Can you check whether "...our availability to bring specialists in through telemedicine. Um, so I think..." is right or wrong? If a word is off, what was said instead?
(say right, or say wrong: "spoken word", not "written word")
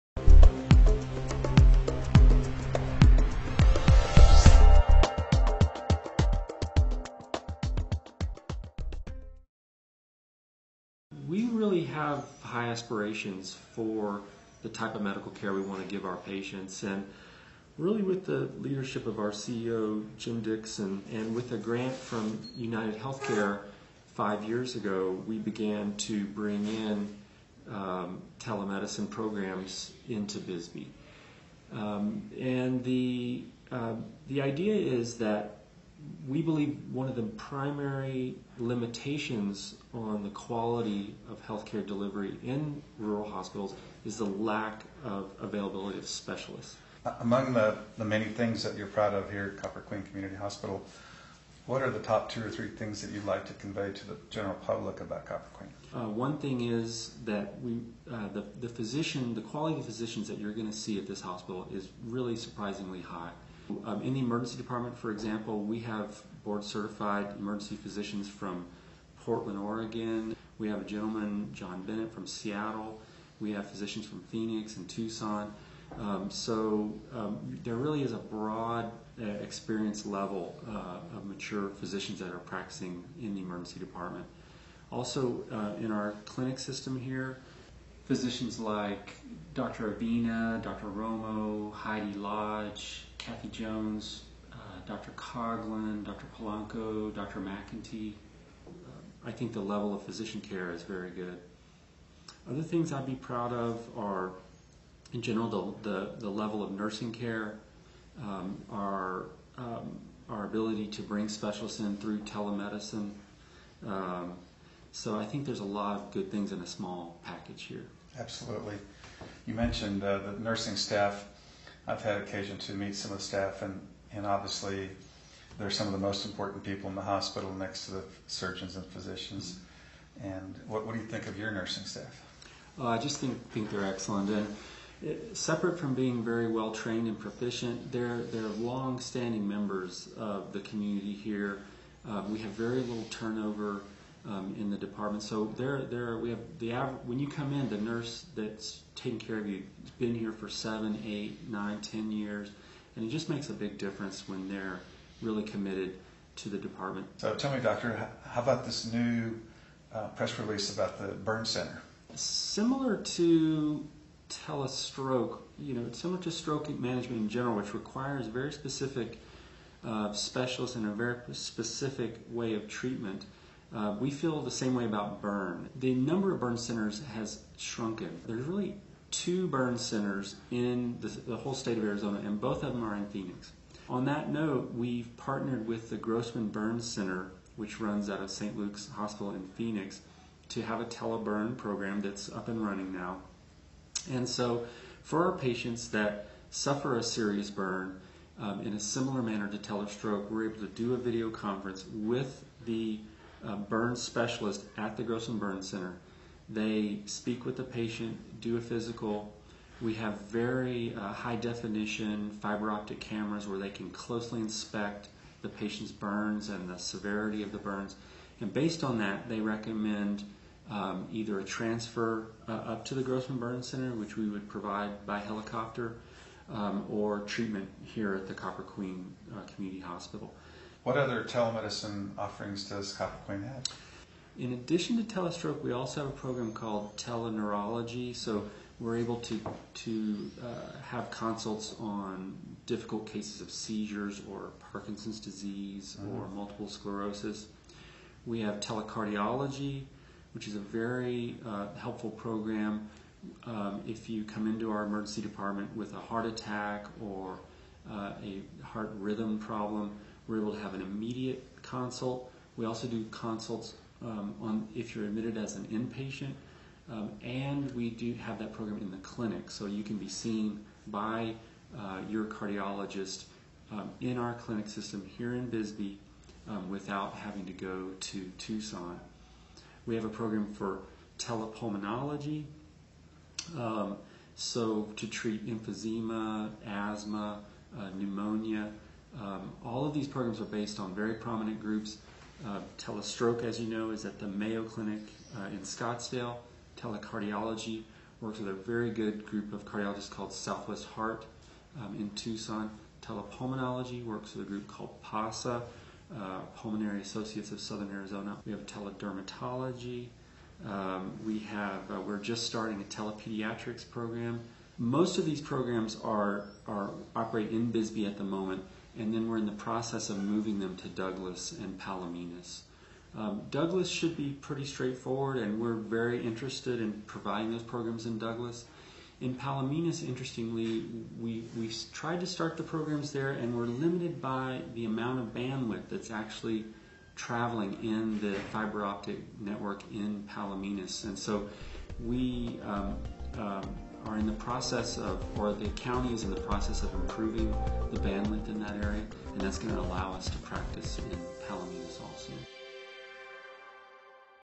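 wrong: "ability", not "availability".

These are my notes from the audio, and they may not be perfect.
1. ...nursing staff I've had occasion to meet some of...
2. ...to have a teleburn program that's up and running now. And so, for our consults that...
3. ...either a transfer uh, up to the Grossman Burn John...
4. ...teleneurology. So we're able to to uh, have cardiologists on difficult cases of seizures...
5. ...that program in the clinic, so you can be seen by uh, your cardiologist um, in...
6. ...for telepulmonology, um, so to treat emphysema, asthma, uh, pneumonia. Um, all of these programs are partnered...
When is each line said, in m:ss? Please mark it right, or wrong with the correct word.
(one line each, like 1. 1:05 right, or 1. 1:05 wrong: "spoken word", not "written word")
1. 2:00 right
2. 3:10 wrong: "patients", not "consults"
3. 3:41 wrong: "Center", not "John"
4. 3:56 wrong: "consults", not "cardiologists"
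5. 4:28 right
6. 4:40 wrong: "based", not "partnered".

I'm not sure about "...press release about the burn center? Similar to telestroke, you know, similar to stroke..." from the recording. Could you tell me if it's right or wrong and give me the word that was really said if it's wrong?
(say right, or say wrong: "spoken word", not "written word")
right.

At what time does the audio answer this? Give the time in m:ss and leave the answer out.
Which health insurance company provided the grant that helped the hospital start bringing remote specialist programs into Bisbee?
0:22.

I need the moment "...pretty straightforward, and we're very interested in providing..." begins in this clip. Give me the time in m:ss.
5:24.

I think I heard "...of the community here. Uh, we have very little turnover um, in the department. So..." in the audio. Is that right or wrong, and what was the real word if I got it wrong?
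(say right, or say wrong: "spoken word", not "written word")
right.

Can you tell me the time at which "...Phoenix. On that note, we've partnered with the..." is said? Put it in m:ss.
3:03.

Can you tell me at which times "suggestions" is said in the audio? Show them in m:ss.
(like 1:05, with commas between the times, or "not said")
not said.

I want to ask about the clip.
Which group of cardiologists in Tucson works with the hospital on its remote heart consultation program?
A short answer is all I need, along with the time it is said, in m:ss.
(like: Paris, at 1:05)
Southwest Heart, at 5:00.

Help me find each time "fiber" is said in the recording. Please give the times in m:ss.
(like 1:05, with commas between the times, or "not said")
3:32, 5:38.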